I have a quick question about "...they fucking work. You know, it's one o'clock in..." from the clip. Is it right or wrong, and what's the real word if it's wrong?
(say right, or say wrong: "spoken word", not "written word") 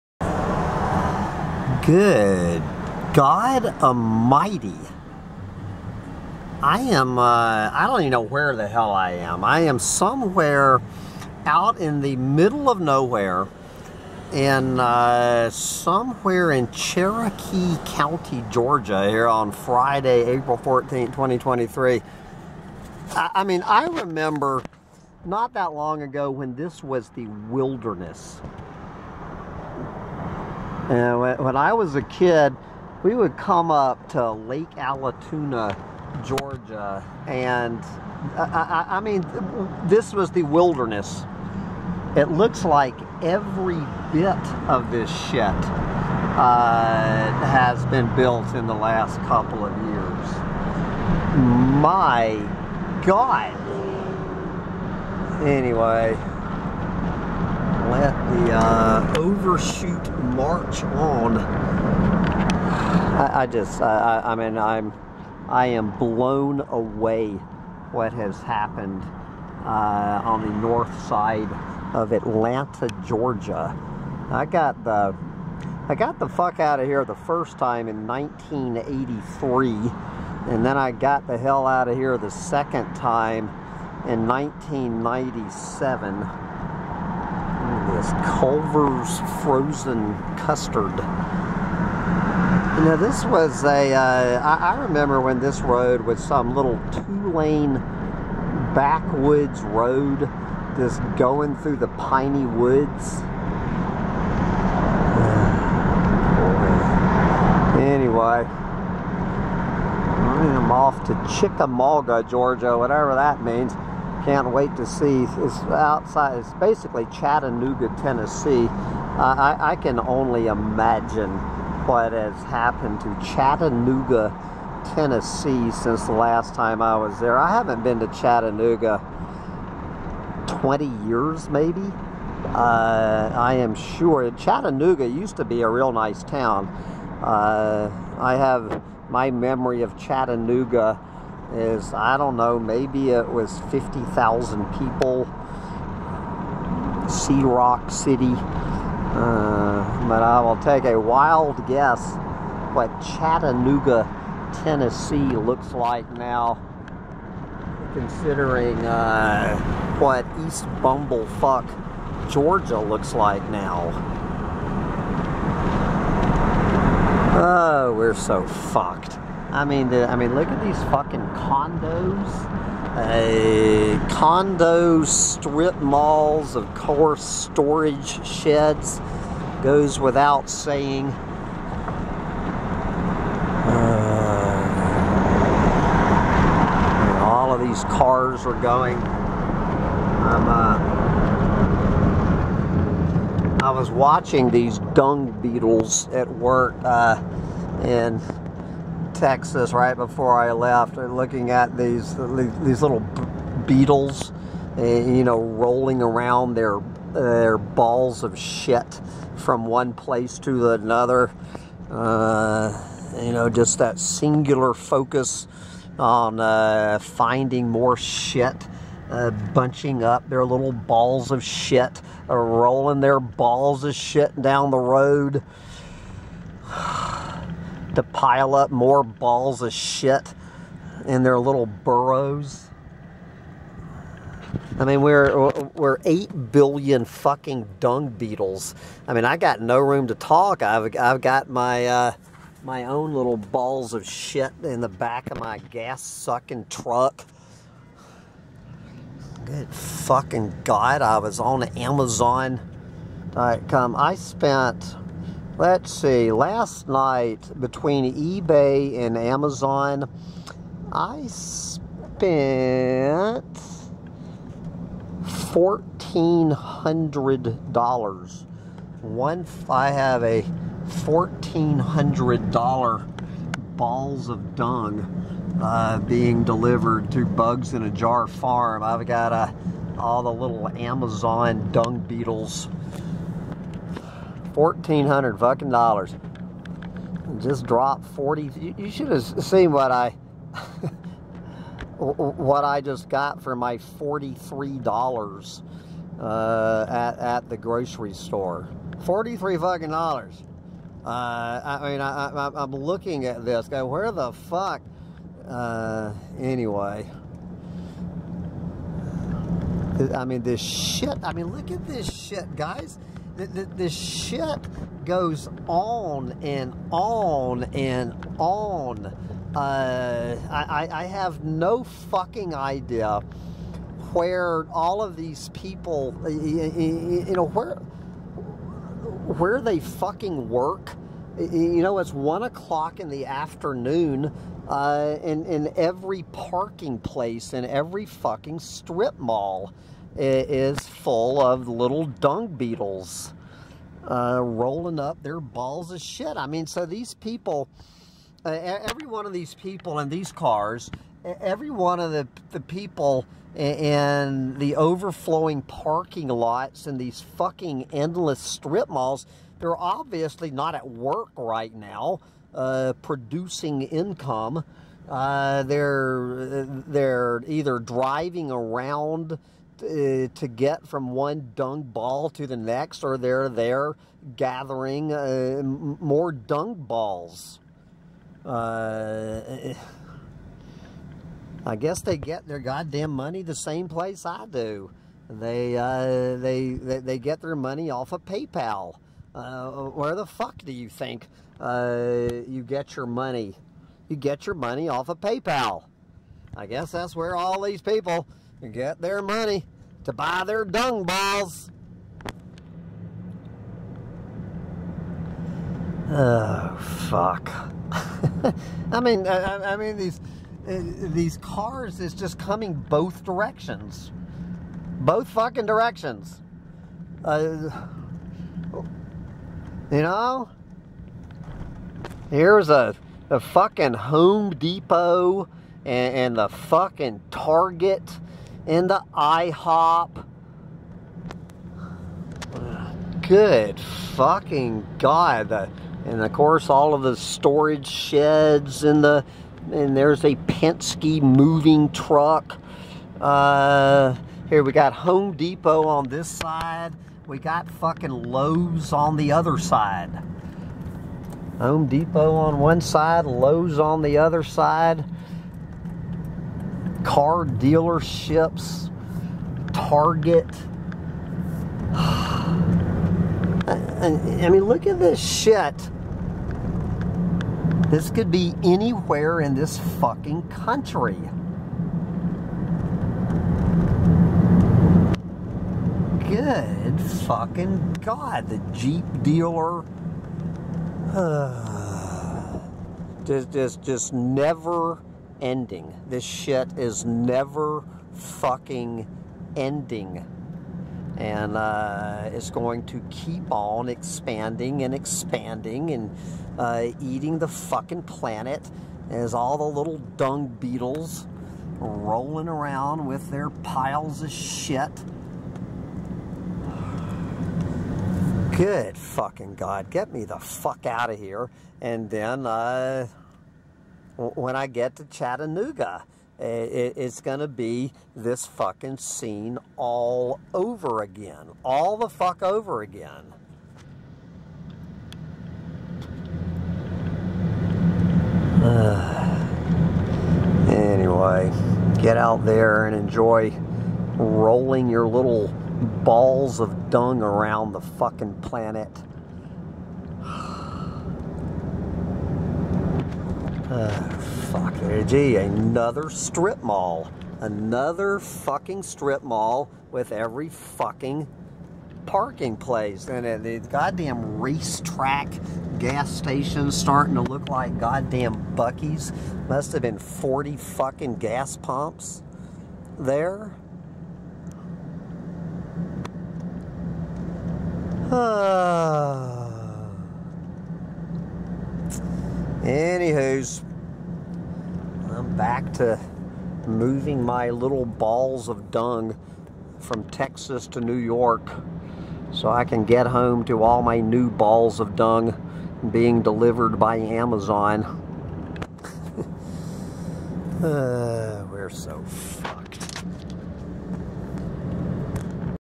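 right.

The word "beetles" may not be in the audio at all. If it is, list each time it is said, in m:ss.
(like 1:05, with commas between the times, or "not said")
3:15, 3:23, 3:58, 4:41, 5:42, 8:20.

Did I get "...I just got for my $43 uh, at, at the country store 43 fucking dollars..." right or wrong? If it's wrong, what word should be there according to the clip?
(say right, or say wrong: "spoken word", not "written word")
wrong: "grocery", not "country".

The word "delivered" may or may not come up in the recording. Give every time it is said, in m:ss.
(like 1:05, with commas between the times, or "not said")
4:36, 9:46.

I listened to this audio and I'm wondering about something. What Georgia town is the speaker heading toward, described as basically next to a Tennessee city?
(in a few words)
Chickamauga.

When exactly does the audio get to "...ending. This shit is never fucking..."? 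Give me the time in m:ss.
8:05.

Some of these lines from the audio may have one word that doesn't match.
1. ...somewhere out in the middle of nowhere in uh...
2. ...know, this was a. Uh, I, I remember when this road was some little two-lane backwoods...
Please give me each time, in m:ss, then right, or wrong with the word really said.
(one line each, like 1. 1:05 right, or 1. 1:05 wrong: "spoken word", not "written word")
1. 0:09 right
2. 1:32 right.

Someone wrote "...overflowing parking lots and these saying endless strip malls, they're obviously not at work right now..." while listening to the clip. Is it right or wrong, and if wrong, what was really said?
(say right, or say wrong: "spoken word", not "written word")
wrong: "fucking", not "saying".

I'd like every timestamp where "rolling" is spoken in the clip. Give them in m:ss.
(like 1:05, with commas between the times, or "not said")
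3:25, 3:42, 5:44, 8:21, 8:54.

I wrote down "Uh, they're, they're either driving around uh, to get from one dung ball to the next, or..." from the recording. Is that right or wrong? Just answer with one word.
right.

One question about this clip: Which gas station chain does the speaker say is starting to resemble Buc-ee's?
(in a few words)
RaceTrac.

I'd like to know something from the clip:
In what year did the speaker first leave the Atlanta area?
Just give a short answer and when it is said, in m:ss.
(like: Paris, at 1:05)
1983, at 1:18.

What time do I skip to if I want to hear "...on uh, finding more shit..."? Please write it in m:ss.
3:35.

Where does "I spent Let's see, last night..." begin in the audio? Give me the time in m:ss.
4:13.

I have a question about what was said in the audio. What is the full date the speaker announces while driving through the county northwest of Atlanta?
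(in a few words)
Friday, April 14, 2023.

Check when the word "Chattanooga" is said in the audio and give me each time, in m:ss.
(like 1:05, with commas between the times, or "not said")
1:57, 2:03, 2:08, 2:14, 2:19, 2:33, 8:35.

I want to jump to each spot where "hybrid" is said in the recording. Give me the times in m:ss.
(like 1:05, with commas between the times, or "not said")
not said.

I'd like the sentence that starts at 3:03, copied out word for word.
Uh, all of these cars are going.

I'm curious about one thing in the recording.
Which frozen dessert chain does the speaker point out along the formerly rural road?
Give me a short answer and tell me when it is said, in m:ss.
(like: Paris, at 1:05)
Culver's, at 1:28.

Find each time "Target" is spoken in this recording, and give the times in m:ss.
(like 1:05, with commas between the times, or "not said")
7:07, 7:39.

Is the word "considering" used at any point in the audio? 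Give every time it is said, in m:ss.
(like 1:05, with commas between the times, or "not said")
2:37.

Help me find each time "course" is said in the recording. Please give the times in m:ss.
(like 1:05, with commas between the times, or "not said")
2:56, 7:16.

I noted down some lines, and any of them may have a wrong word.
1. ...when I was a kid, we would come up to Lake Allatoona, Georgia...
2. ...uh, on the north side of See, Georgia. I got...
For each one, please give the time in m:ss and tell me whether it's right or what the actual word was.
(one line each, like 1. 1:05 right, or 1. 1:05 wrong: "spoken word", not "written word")
1. 0:31 right
2. 1:09 wrong: "Atlanta", not "See".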